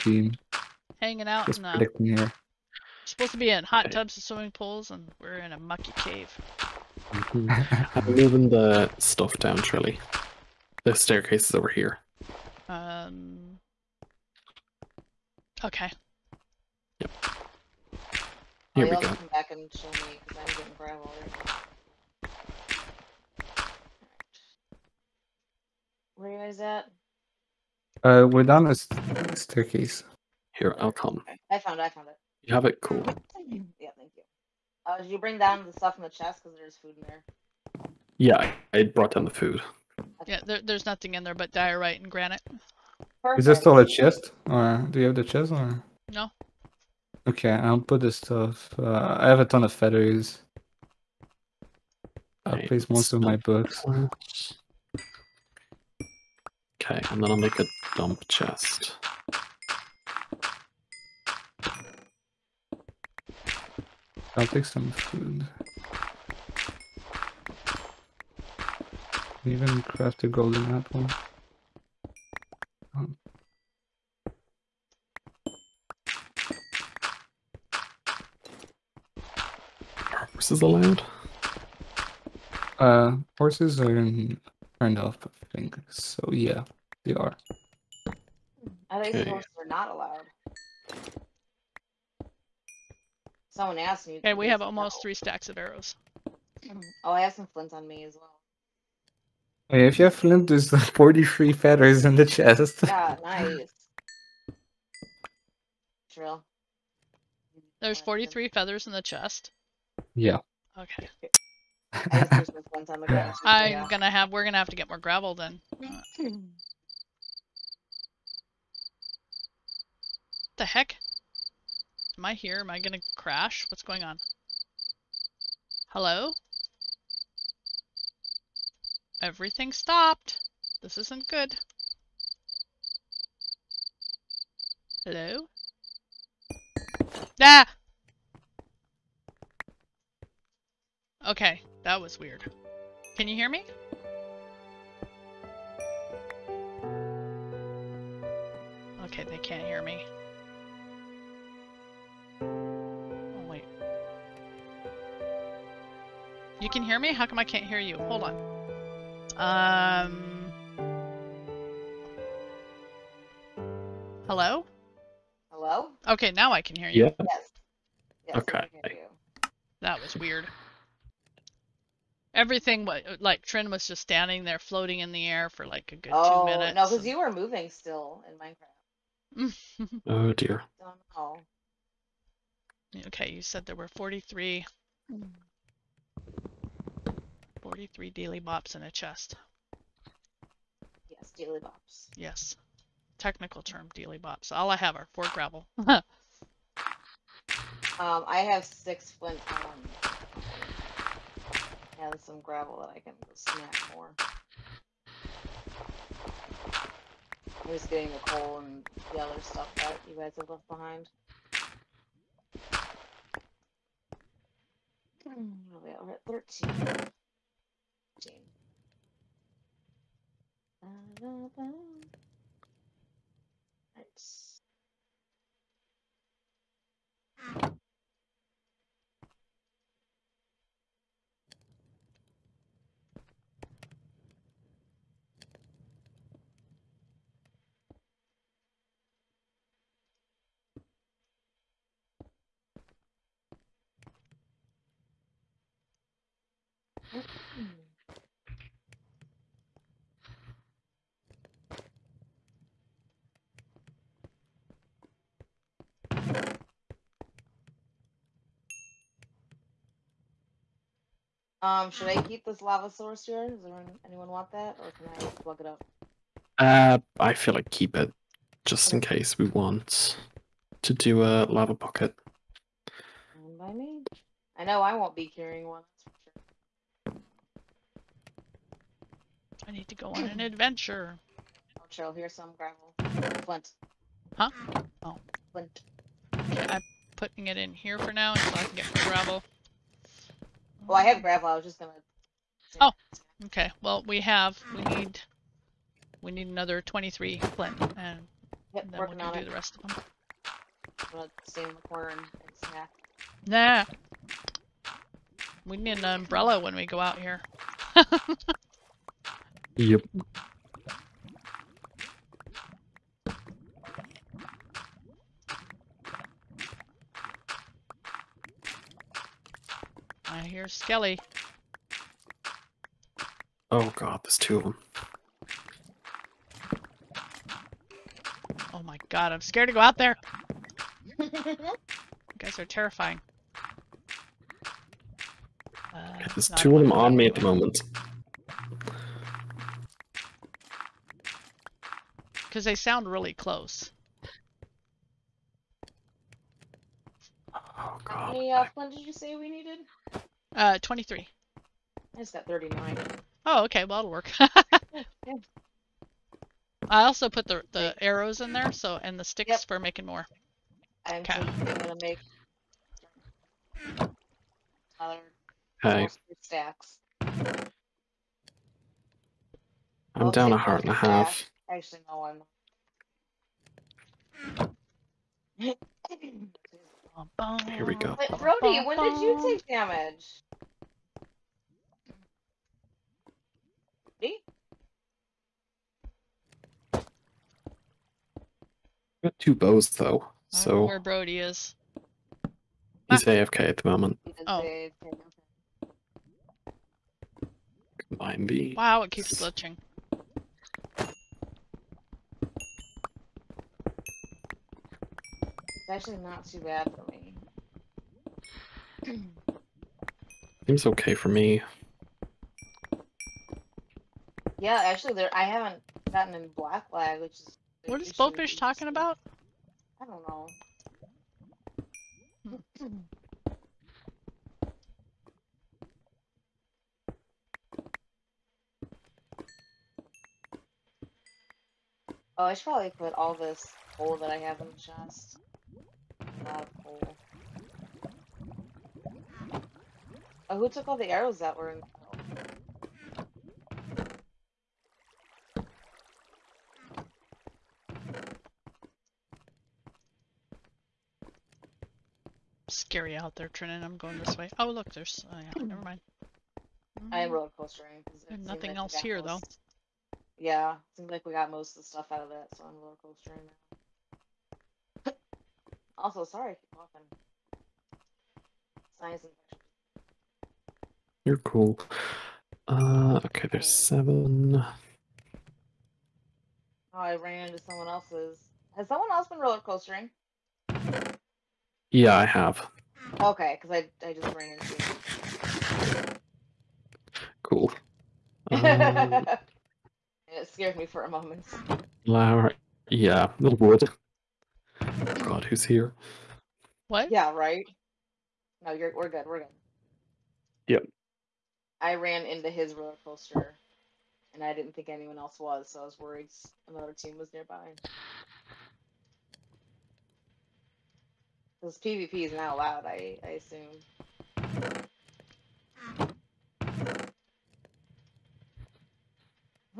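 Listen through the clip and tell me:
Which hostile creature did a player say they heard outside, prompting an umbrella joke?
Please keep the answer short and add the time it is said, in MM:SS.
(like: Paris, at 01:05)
Skelly, at 05:20.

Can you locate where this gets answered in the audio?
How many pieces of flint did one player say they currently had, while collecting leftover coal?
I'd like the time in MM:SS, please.
03:18.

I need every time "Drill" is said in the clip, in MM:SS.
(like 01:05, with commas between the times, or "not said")
01:46.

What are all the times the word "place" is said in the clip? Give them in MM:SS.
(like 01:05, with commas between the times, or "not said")
00:52.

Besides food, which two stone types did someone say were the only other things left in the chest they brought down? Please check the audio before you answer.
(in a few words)
diorite and granite.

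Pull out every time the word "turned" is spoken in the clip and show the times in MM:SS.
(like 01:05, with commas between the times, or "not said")
01:24.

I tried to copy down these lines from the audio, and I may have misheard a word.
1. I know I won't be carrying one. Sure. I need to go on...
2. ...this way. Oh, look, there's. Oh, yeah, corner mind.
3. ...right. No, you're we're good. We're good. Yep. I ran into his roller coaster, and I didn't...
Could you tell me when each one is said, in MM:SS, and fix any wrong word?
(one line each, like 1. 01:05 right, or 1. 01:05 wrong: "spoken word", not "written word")
1. 04:34 right
2. 07:34 wrong: "never", not "corner"
3. 08:17 right.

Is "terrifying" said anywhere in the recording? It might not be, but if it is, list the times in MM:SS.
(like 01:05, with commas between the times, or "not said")
05:32.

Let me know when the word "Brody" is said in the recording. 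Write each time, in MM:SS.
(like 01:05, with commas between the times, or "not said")
06:18, 06:30.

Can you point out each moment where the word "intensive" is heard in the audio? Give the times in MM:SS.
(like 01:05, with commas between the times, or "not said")
not said.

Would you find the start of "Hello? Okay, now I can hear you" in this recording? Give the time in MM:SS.
02:45.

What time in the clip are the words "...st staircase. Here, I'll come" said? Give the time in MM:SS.
00:28.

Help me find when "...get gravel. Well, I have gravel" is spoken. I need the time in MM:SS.
04:48.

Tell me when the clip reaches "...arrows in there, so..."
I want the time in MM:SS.
05:58.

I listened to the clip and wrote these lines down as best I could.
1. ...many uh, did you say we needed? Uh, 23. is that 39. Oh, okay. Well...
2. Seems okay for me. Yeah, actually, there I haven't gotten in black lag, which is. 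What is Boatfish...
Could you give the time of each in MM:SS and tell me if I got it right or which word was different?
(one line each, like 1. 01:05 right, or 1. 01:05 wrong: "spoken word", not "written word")
1. 05:48 right
2. 06:50 right.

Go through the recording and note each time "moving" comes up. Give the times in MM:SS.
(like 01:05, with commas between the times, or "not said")
00:08, 02:57.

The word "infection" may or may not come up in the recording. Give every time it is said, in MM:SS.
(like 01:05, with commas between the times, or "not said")
07:49.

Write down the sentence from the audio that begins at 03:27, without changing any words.
I'm just getting the coal and the other stuff that you guys have left behind.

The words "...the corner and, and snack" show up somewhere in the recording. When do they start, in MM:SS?
05:01.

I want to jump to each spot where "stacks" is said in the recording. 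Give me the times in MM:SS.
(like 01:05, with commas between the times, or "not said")
01:35, 06:06.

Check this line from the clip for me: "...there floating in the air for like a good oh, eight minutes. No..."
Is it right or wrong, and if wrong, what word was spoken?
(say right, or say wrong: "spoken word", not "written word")
wrong: "two", not "eight".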